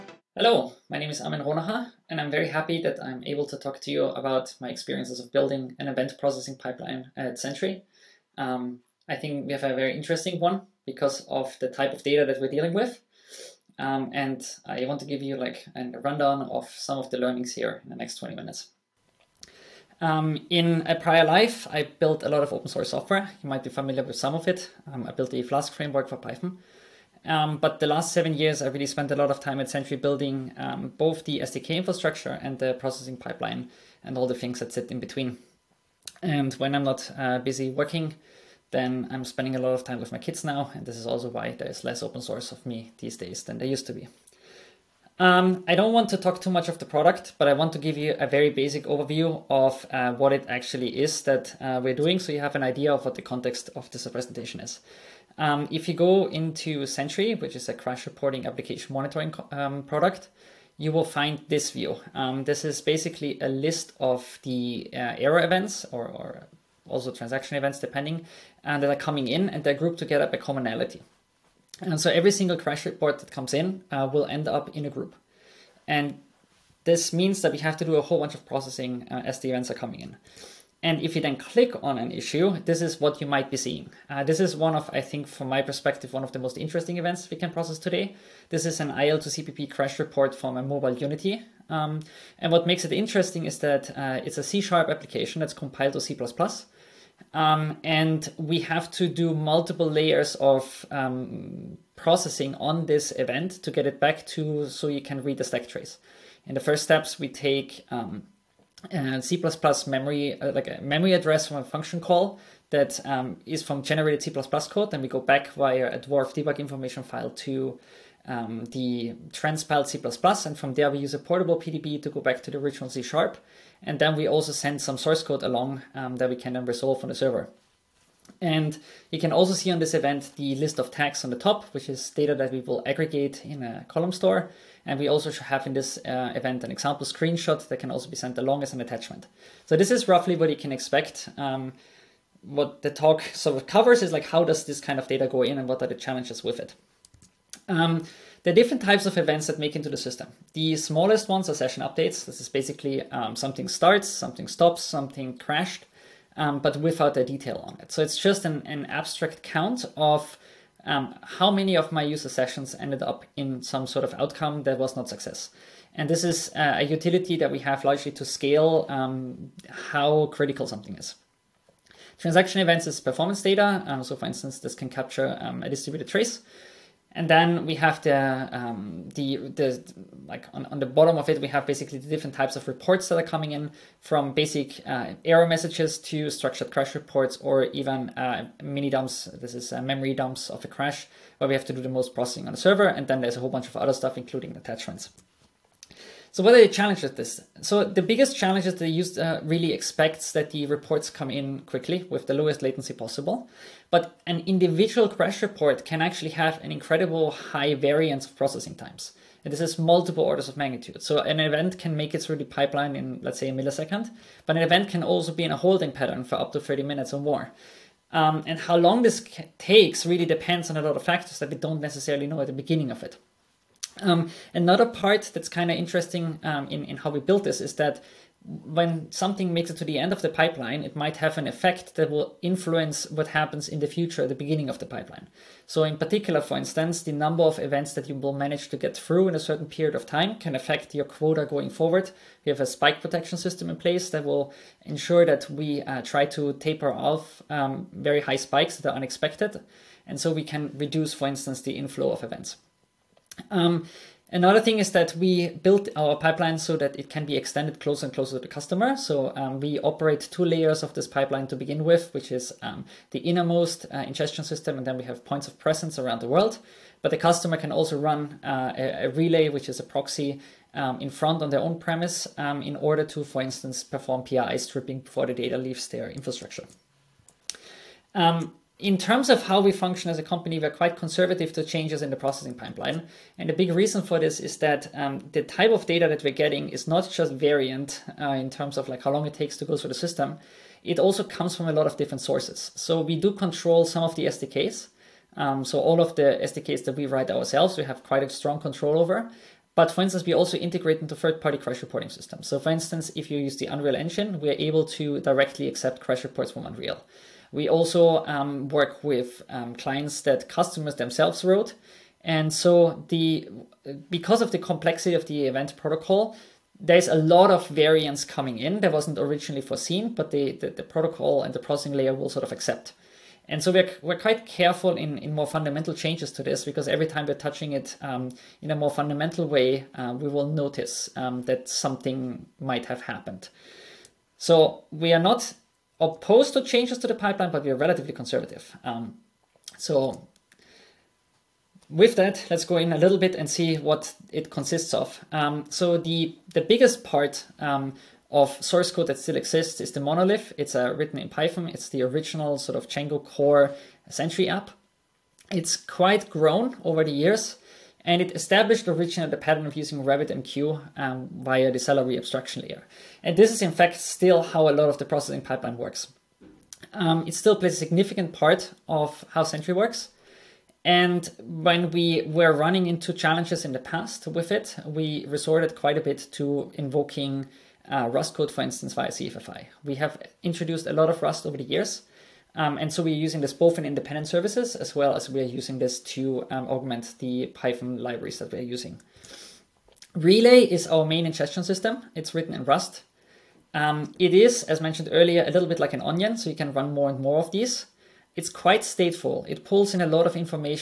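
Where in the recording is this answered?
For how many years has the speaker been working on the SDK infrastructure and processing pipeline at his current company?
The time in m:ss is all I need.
0:28.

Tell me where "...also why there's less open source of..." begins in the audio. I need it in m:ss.
0:41.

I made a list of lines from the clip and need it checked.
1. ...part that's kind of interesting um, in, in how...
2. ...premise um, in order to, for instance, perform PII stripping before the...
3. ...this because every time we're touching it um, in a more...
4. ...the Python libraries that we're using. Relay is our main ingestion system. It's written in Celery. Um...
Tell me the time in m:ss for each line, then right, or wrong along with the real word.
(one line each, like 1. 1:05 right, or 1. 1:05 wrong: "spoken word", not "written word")
1. 3:44 right
2. 4:31 right
3. 5:26 right
4. 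6:27 wrong: "Rust", not "Celery".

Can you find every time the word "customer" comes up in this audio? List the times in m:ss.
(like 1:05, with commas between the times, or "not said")
4:18, 4:27, 5:10.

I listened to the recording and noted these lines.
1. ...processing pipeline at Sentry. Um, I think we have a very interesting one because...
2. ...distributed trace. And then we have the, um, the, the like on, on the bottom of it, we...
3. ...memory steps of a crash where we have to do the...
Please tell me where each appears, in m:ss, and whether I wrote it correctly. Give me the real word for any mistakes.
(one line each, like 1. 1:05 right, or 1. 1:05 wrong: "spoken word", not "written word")
1. 0:06 right
2. 2:55 right
3. 3:09 wrong: "dumps", not "steps".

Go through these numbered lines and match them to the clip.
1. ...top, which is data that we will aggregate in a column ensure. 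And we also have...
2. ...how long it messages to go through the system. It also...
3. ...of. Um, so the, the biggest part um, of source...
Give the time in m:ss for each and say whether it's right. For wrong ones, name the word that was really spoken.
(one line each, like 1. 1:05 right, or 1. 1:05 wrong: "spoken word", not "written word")
1. 2:11 wrong: "store", not "ensure"
2. 4:49 wrong: "takes", not "messages"
3. 5:44 right.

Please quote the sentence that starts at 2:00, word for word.
And from there, we use a portable PDB to go back to the original C Sharp.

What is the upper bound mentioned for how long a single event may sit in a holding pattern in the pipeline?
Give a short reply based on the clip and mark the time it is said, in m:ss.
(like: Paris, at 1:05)
30 minutes, at 3:36.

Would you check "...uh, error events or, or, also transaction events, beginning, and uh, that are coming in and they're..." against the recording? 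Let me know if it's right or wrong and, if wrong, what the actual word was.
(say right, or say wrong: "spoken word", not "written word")
wrong: "depending", not "beginning".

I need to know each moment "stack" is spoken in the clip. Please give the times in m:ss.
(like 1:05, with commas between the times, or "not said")
1:45.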